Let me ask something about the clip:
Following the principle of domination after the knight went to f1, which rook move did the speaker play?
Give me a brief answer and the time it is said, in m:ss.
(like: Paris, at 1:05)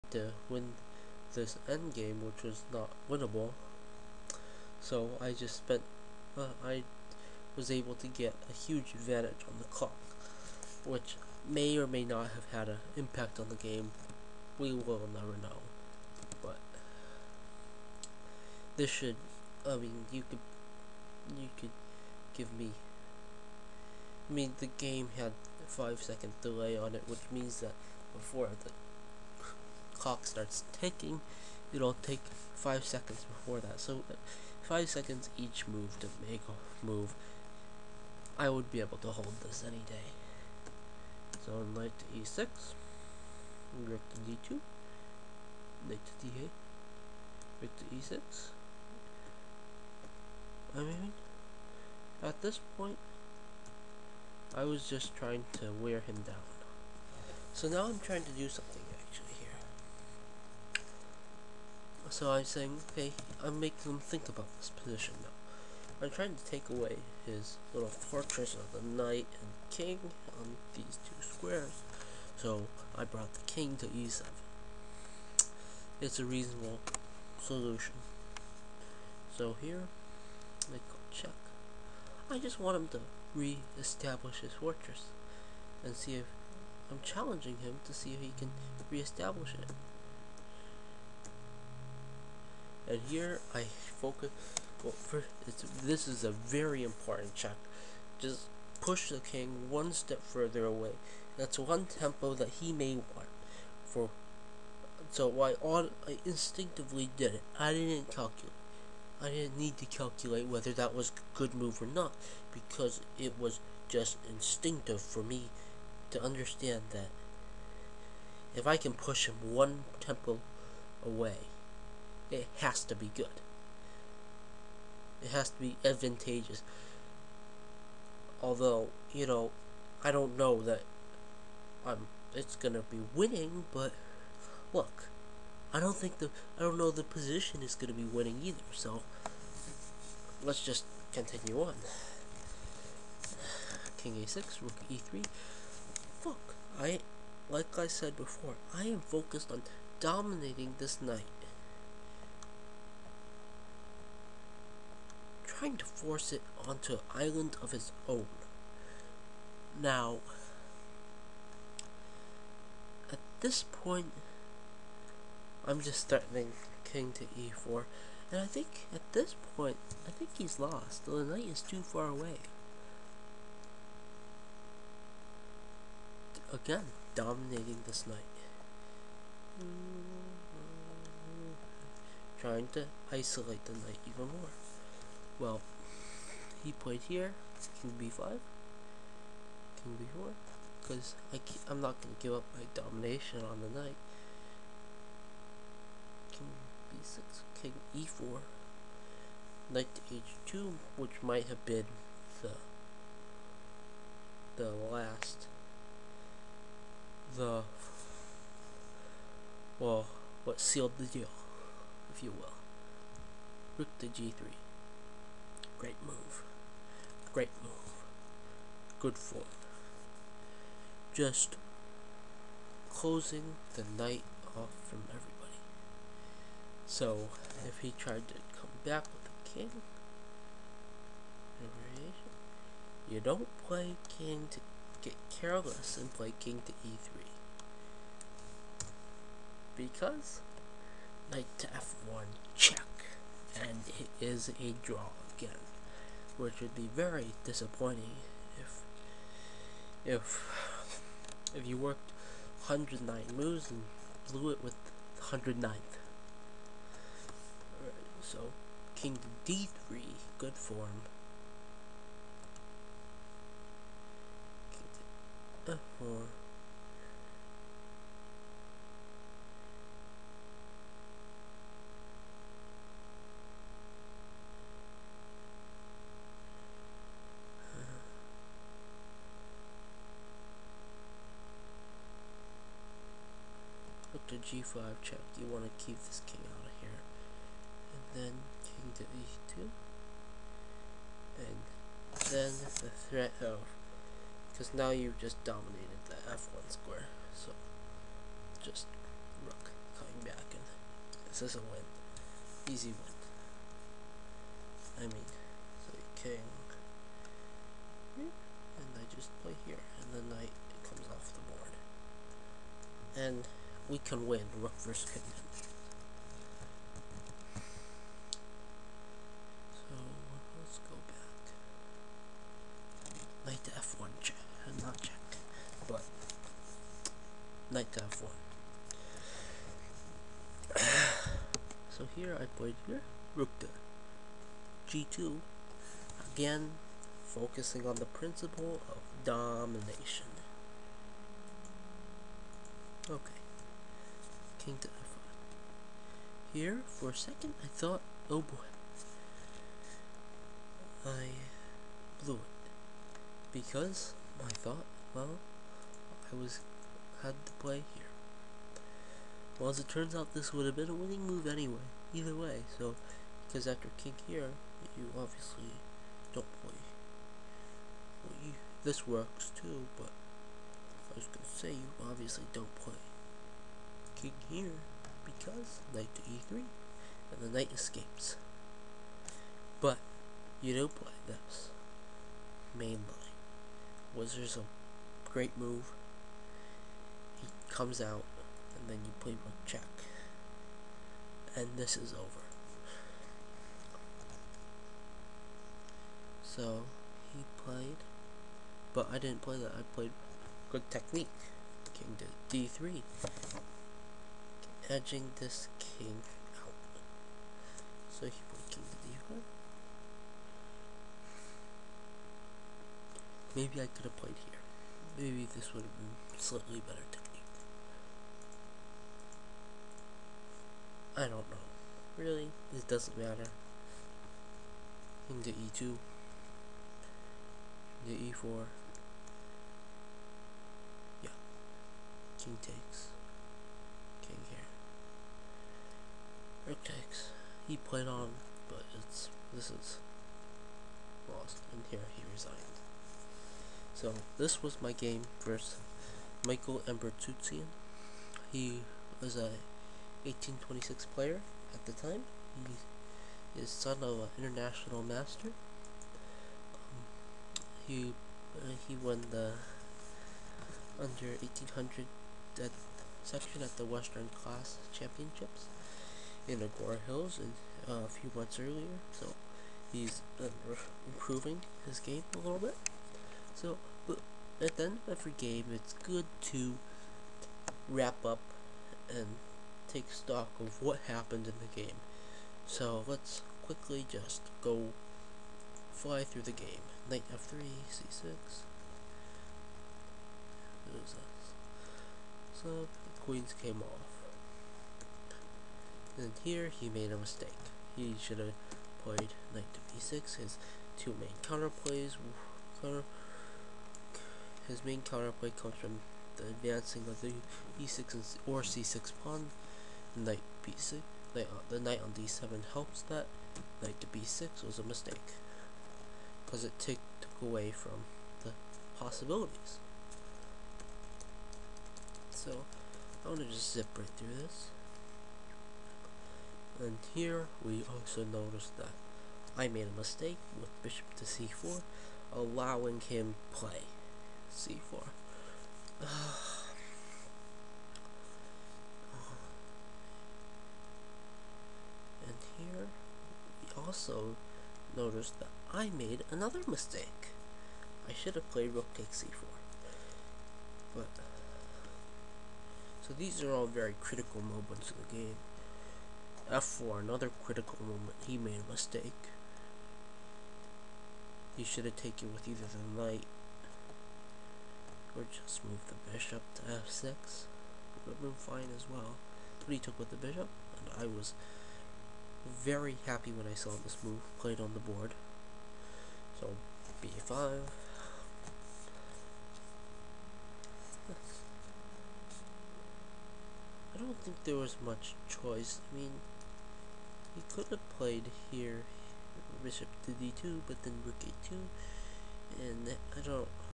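Rook to g2, at 5:33.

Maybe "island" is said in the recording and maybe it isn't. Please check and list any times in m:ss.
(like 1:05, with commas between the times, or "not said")
2:37.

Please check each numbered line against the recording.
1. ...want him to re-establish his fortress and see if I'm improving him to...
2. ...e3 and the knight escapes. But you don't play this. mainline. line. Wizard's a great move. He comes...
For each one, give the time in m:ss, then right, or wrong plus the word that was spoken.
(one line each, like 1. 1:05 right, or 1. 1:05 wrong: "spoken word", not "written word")
1. 1:22 wrong: "challenging", not "improving"
2. 6:16 right.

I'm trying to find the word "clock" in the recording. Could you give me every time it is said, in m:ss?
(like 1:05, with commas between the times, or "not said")
0:09, 0:30.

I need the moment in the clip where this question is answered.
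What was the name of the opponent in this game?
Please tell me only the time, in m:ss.
7:26.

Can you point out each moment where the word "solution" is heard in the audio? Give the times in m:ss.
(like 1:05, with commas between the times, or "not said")
1:17.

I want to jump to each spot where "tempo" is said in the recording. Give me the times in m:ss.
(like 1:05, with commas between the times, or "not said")
1:41, 2:00.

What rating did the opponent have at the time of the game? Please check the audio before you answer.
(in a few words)
1826.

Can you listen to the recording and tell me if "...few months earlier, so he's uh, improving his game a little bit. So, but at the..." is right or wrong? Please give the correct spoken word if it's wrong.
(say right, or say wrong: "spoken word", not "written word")
right.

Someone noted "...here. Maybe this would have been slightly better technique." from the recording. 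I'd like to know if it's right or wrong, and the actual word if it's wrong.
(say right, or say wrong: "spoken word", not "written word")
right.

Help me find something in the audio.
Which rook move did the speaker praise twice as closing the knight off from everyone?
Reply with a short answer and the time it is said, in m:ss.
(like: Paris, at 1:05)
Rook to g3, at 3:33.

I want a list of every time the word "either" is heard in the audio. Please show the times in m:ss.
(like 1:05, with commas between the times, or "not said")
2:18, 6:02, 9:22.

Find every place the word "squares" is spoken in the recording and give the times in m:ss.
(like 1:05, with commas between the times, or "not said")
1:11, 4:56.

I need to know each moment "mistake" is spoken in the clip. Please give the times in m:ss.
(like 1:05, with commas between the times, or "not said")
8:17, 8:34, 8:49, 9:06, 9:18.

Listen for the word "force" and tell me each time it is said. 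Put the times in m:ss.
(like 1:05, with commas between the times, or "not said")
2:35.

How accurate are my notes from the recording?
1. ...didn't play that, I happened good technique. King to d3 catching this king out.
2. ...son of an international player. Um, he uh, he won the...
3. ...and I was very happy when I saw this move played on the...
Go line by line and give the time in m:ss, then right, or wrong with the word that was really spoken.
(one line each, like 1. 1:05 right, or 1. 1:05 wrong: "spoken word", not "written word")
1. 6:39 wrong: "played", not "happened"
2. 7:33 wrong: "master", not "player"
3. 9:30 right.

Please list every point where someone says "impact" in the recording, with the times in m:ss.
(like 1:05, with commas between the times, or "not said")
0:12.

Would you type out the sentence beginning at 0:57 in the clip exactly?
So now I'm trying to do something.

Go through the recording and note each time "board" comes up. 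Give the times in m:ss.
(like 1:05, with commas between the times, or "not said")
5:11, 9:34.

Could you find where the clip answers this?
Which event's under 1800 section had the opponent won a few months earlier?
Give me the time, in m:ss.
7:43.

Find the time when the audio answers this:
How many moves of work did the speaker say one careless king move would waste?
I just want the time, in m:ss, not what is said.
4:12.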